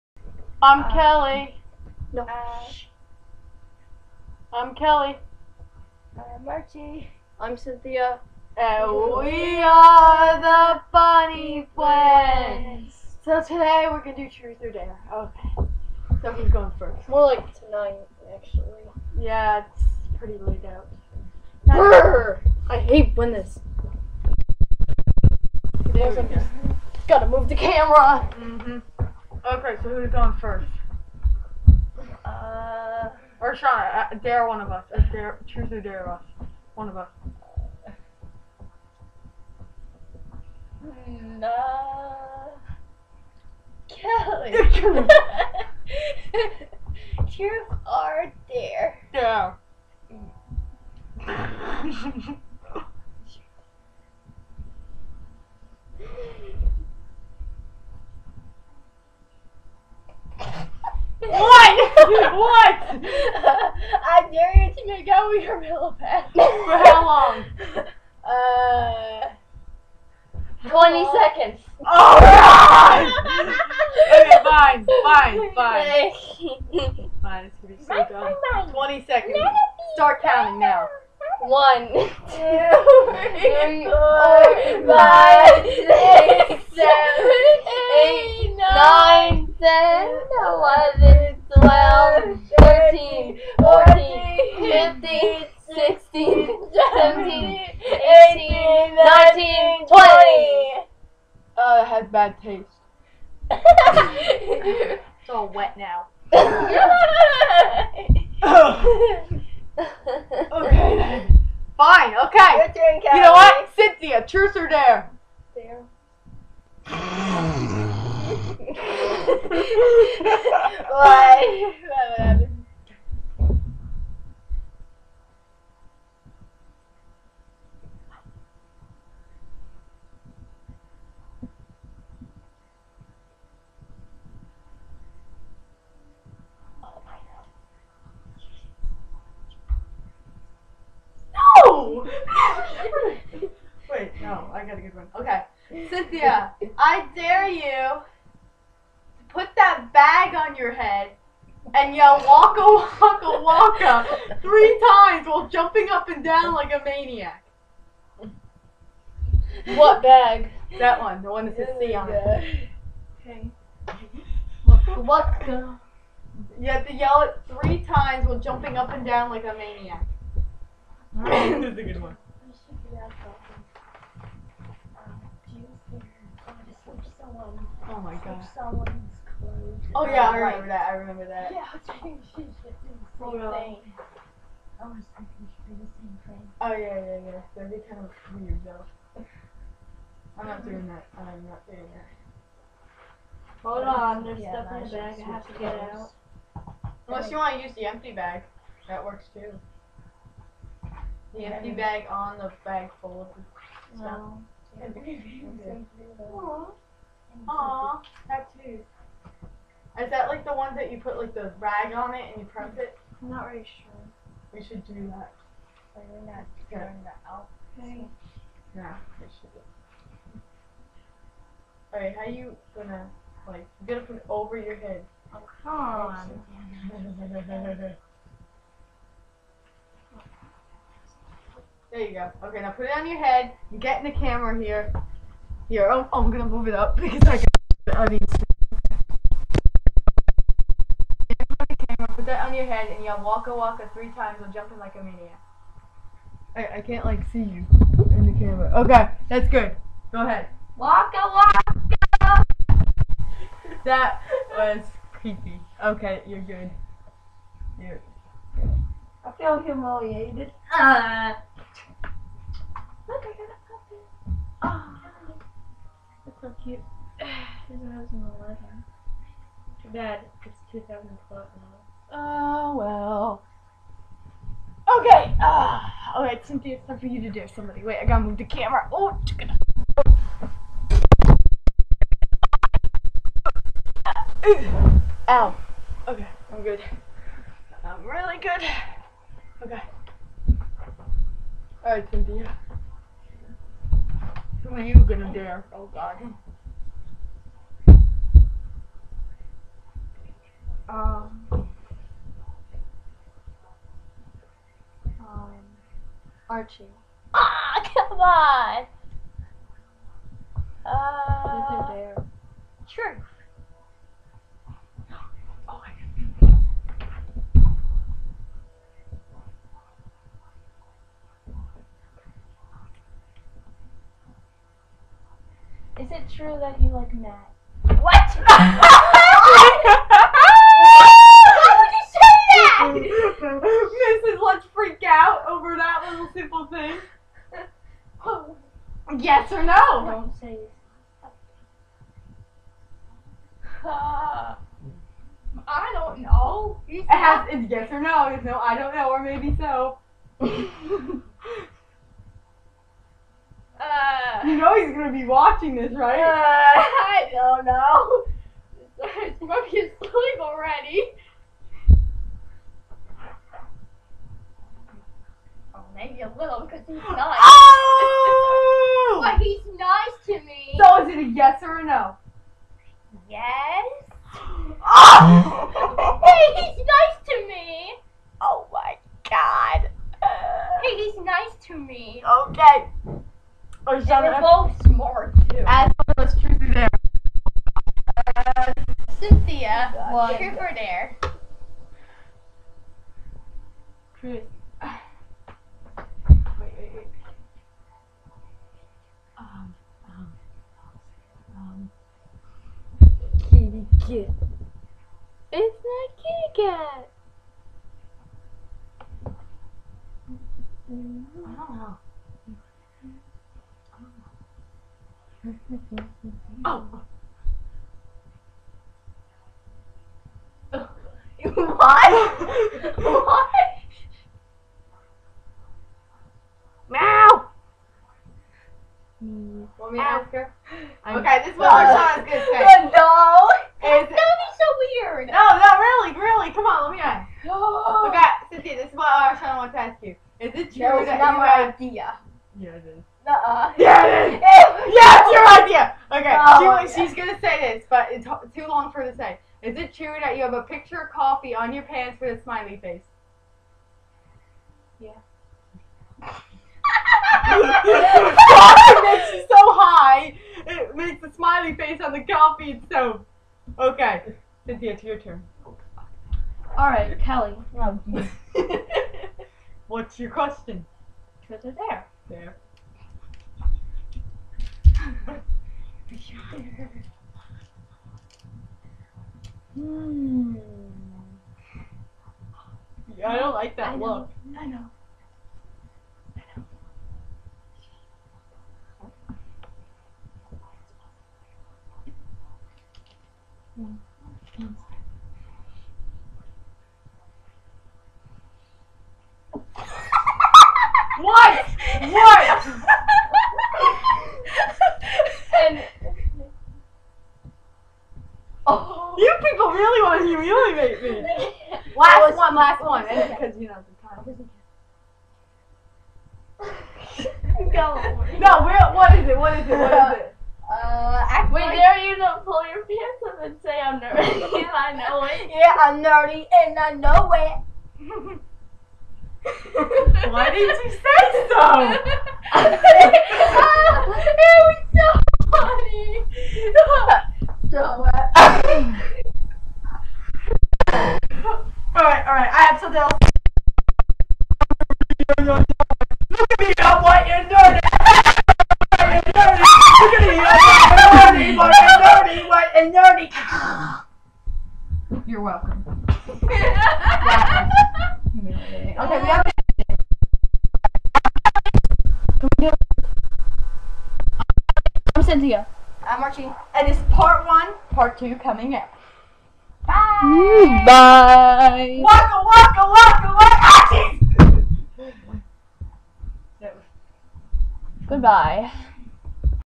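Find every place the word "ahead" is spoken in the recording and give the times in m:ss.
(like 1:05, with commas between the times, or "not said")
4:10.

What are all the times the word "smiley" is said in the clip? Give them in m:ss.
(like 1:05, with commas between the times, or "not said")
7:32, 7:41.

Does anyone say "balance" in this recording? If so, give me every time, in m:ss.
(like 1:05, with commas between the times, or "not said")
not said.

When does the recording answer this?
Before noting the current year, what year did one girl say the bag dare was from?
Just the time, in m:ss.
4:28.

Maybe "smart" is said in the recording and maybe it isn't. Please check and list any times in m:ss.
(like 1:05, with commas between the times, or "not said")
6:24.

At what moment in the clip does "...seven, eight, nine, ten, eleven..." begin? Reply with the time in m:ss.
1:26.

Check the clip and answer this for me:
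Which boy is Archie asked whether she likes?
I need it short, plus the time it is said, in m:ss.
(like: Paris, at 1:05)
Matt, at 5:27.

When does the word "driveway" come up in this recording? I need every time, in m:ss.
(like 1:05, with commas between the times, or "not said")
not said.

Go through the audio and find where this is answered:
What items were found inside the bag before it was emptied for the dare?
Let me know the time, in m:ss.
3:28.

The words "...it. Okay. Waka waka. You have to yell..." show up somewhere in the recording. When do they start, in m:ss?
2:42.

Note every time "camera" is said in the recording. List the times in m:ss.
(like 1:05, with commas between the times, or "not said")
0:27, 3:54, 4:01, 4:08, 4:38.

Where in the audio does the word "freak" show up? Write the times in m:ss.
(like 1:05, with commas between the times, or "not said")
5:34.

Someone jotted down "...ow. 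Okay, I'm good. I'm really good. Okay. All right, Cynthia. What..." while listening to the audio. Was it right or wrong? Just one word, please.
right.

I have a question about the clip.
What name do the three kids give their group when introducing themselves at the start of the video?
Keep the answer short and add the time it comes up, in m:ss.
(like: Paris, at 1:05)
The Funny Friends, at 0:10.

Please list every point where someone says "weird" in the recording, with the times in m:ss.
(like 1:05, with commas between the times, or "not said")
3:08, 7:15.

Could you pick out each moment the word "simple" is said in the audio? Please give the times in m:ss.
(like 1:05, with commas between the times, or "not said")
5:36.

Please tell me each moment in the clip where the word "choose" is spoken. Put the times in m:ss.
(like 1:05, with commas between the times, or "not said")
0:35, 0:47.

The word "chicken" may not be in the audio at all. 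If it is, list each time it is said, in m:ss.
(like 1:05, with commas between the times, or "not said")
4:39.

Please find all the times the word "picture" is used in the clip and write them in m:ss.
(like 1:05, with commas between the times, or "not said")
7:30.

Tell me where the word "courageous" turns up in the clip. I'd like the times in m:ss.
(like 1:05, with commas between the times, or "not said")
not said.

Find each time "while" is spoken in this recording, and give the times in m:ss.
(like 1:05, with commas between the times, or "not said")
2:35, 2:48, 4:04.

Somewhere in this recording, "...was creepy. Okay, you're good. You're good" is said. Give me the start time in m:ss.
4:14.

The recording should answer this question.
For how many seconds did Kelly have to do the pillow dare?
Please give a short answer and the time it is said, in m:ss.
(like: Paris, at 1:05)
20, at 1:10.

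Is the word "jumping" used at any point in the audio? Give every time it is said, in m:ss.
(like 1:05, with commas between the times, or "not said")
2:35, 2:48, 4:04.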